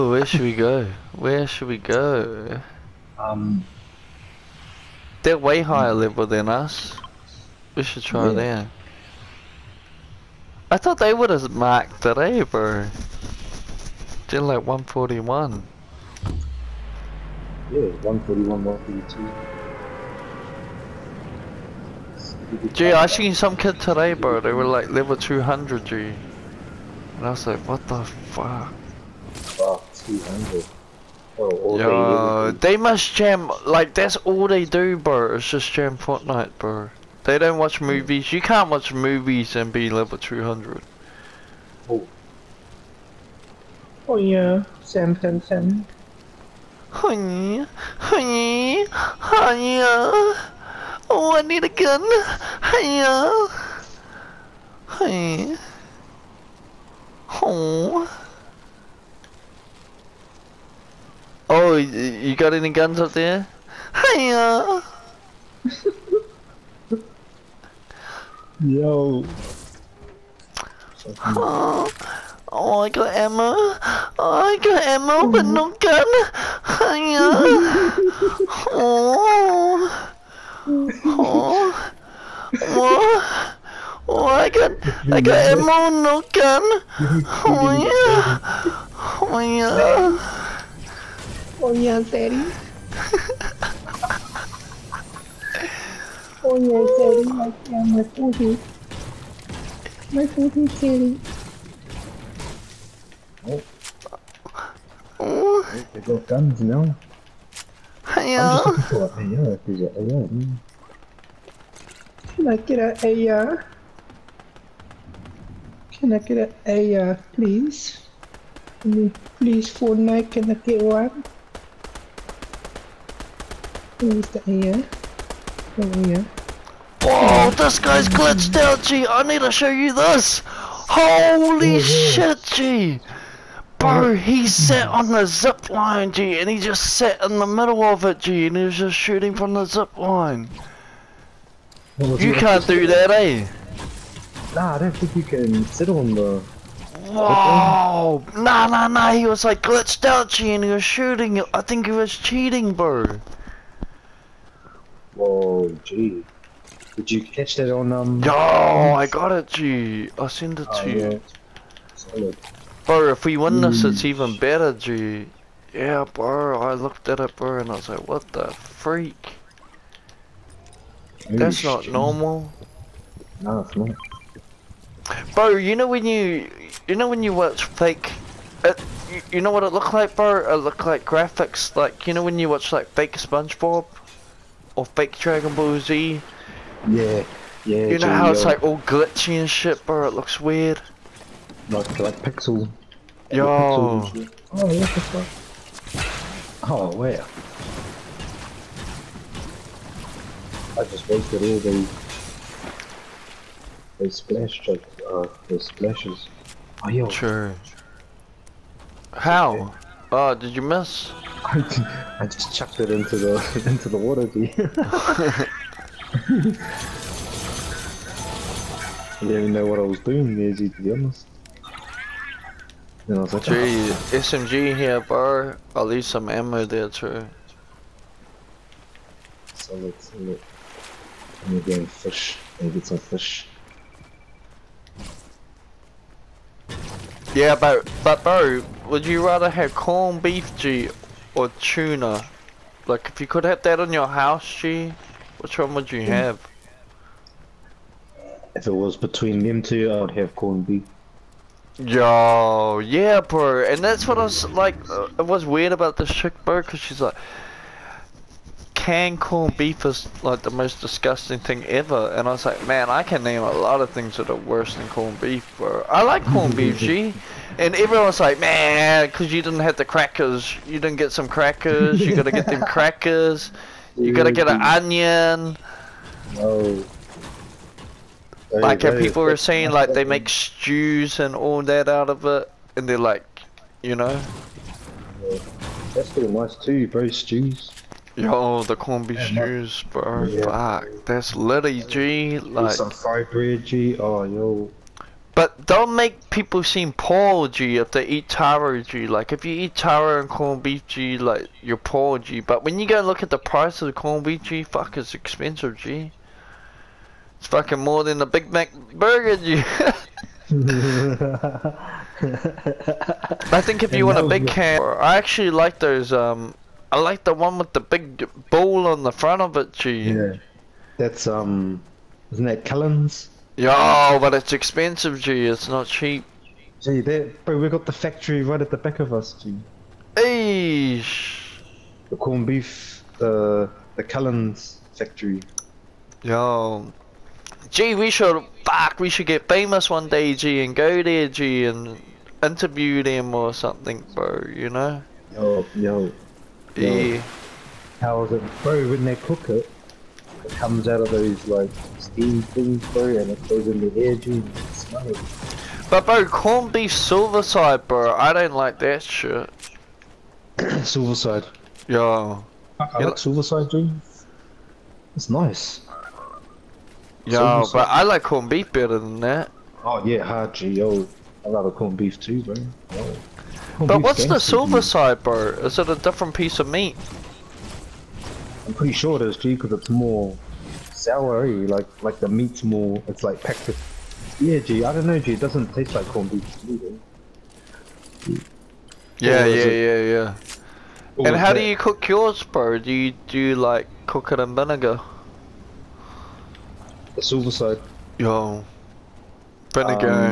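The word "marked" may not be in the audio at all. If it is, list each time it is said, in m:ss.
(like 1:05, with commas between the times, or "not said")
0:11.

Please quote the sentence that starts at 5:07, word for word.
It's fucking more than a Big Mac burger, you.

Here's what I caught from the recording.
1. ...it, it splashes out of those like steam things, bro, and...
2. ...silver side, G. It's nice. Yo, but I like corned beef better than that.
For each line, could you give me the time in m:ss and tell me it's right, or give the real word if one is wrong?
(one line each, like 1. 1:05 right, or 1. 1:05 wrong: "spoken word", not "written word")
1. 5:49 wrong: "comes", not "splashes"
2. 6:03 right.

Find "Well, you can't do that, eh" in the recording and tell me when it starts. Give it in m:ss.
2:21.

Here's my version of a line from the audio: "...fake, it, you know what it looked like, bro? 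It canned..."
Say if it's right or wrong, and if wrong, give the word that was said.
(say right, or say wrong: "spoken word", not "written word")
wrong: "looked", not "canned".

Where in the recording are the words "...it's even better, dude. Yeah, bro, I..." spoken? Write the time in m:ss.
2:43.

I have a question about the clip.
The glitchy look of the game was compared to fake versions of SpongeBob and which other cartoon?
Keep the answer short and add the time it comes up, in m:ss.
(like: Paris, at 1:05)
Dragon Ball Z, at 3:05.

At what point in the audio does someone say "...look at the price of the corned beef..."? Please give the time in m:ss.
5:03.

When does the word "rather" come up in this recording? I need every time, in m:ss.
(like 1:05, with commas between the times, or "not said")
3:59, 6:11.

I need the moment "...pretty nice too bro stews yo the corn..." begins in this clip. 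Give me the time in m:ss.
4:46.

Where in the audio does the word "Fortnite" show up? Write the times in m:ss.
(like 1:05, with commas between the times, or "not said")
0:35, 1:59.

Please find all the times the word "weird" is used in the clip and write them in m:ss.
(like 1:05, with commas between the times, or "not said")
3:10, 4:15.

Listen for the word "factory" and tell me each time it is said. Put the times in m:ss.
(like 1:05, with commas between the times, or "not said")
5:27, 5:34.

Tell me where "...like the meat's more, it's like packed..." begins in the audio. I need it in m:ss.
6:22.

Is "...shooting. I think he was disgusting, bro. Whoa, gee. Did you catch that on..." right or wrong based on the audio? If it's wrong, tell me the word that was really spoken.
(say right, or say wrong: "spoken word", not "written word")
wrong: "cheating", not "disgusting".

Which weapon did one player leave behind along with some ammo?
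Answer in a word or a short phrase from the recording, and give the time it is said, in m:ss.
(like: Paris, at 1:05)
SMG, at 3:44.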